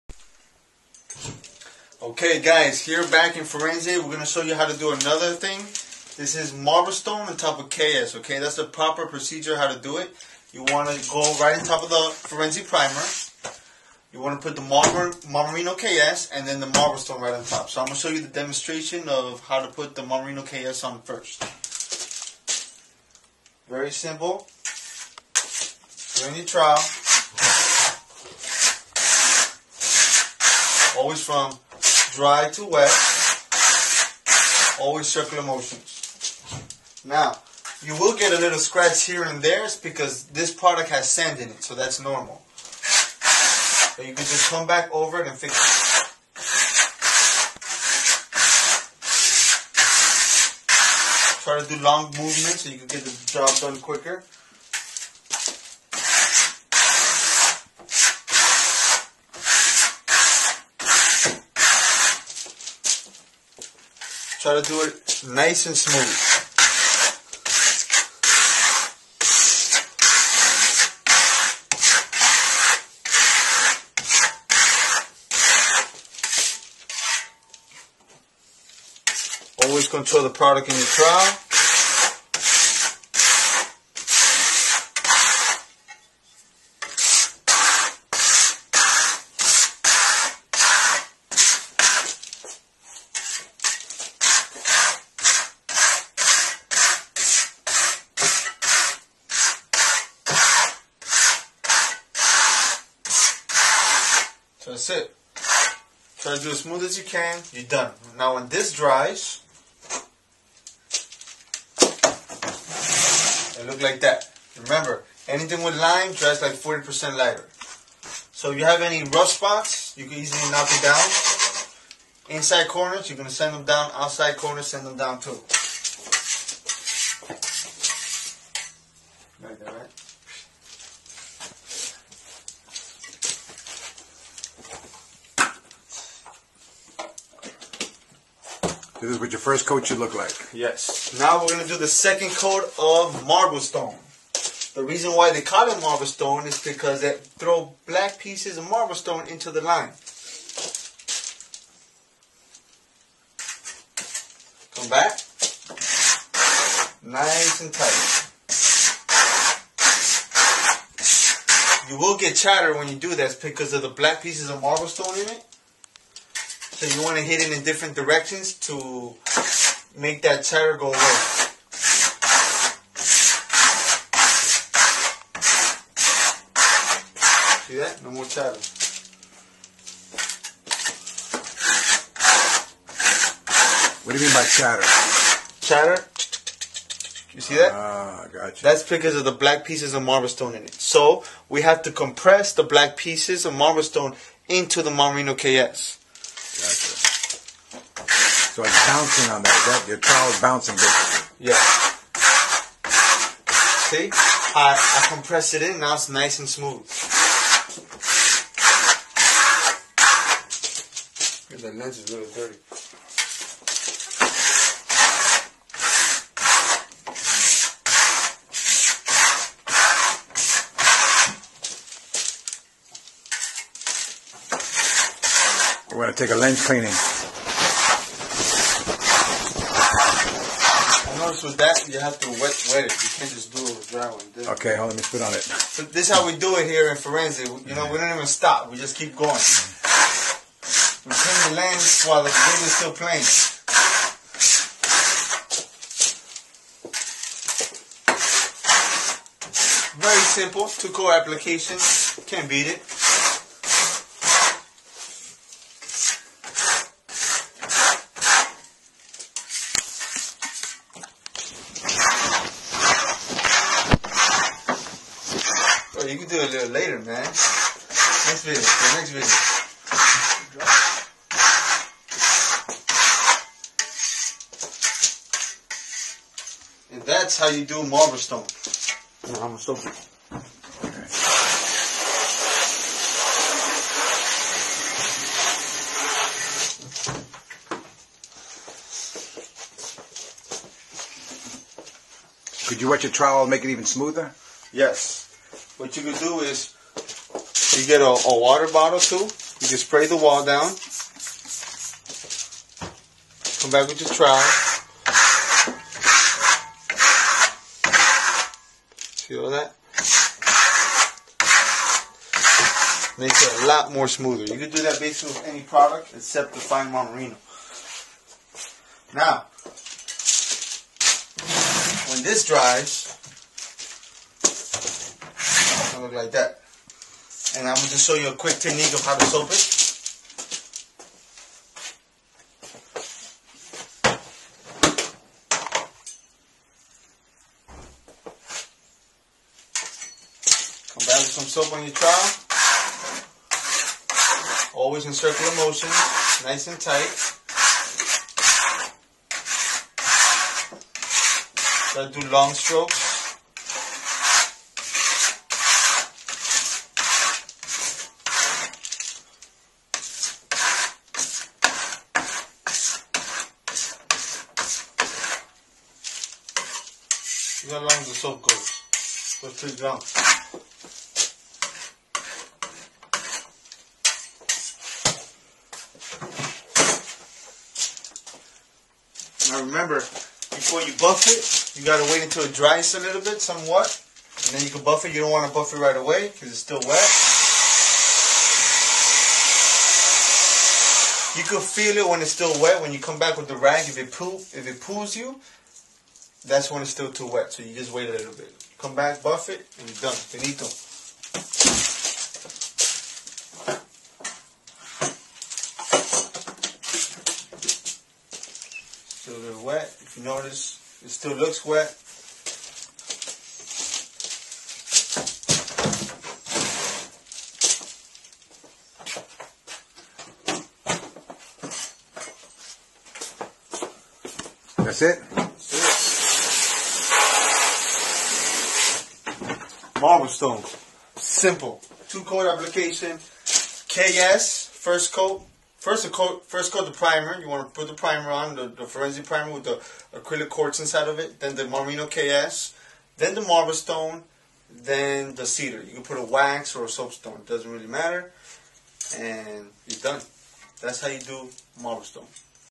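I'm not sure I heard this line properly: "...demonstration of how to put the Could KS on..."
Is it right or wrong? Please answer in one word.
wrong.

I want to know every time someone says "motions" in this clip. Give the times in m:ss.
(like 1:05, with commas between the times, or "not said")
0:35, 5:45.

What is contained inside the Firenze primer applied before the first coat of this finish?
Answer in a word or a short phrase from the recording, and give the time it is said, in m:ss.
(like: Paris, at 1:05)
acrylic quartz, at 7:20.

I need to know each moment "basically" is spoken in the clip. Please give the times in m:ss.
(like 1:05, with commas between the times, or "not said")
3:20, 5:14.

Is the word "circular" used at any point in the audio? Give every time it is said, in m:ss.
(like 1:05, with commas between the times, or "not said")
0:35, 5:45.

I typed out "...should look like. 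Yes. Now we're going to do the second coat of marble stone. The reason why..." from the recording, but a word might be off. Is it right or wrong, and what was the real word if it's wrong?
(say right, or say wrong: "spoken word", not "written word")
right.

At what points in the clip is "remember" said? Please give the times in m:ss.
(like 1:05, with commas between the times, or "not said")
1:54, 6:19.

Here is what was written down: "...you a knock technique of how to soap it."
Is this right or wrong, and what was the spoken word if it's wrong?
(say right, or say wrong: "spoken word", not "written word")
wrong: "quick", not "knock".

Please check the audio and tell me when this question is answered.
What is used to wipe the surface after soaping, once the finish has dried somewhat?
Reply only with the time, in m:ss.
6:33.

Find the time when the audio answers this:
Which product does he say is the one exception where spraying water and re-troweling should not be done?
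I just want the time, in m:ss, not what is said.
5:16.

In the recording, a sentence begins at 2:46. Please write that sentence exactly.
So you want to hit it in different directions to make that chatter go away.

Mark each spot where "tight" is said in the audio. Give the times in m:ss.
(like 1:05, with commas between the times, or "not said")
2:37, 5:46.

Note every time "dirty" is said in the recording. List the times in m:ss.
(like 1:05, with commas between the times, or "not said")
3:45.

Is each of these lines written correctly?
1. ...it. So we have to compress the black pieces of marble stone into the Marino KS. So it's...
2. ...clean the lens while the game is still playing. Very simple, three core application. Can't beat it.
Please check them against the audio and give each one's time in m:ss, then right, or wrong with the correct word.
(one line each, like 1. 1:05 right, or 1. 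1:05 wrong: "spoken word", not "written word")
1. 3:10 right
2. 4:01 wrong: "two", not "three".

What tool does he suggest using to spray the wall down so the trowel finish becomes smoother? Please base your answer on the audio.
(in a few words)
water bottle.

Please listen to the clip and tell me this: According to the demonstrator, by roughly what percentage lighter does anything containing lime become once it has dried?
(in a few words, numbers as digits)
40%.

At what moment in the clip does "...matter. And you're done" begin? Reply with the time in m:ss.
7:27.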